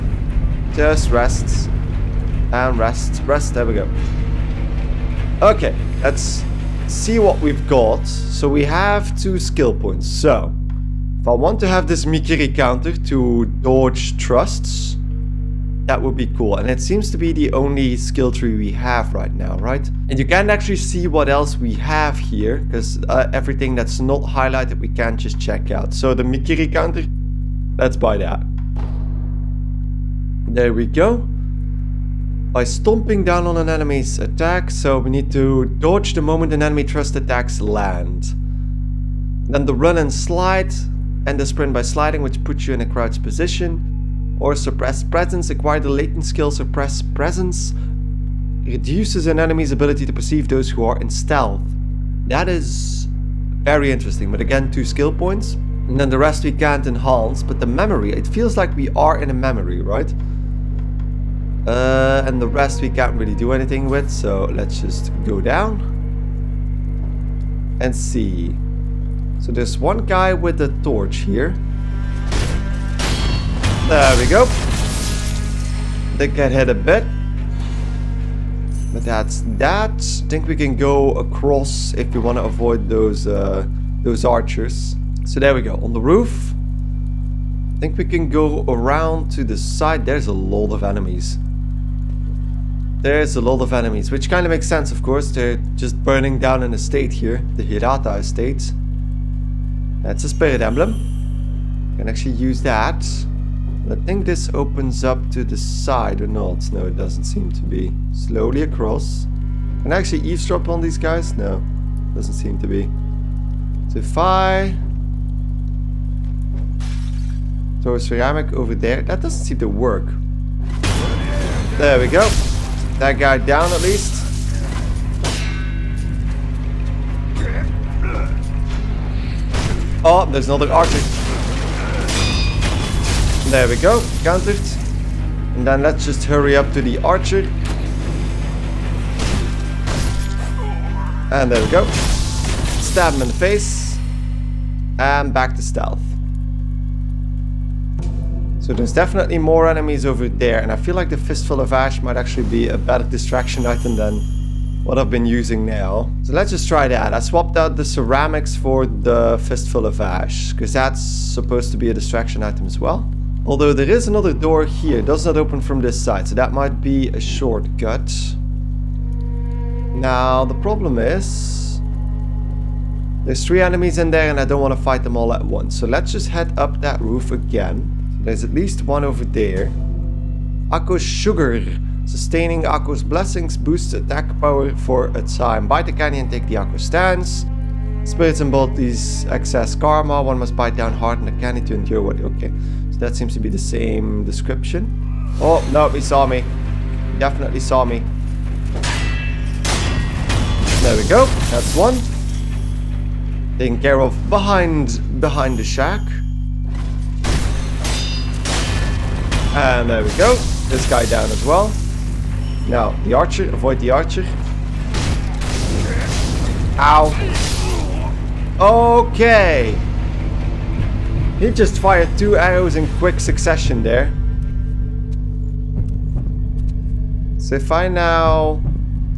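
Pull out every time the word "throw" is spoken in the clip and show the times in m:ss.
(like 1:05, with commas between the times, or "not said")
1:57.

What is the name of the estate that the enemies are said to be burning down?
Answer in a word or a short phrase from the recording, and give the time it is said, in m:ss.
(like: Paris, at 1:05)
Hirata estate, at 1:37.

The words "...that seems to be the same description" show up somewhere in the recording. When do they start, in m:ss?
3:13.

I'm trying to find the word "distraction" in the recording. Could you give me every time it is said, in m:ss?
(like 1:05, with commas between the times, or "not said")
2:33, 2:41.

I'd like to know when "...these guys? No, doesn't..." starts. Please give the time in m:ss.
1:50.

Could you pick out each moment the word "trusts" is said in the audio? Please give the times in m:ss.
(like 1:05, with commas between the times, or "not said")
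0:14.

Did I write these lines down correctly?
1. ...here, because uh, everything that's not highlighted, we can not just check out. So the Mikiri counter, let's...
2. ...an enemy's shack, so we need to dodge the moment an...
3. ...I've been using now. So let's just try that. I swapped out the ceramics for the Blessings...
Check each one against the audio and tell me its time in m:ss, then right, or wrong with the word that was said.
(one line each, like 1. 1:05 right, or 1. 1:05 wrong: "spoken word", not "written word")
1. 0:22 right
2. 0:33 wrong: "attack", not "shack"
3. 2:34 wrong: "Fistful", not "Blessings".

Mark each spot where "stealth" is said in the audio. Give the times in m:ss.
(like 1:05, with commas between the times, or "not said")
0:51, 2:25.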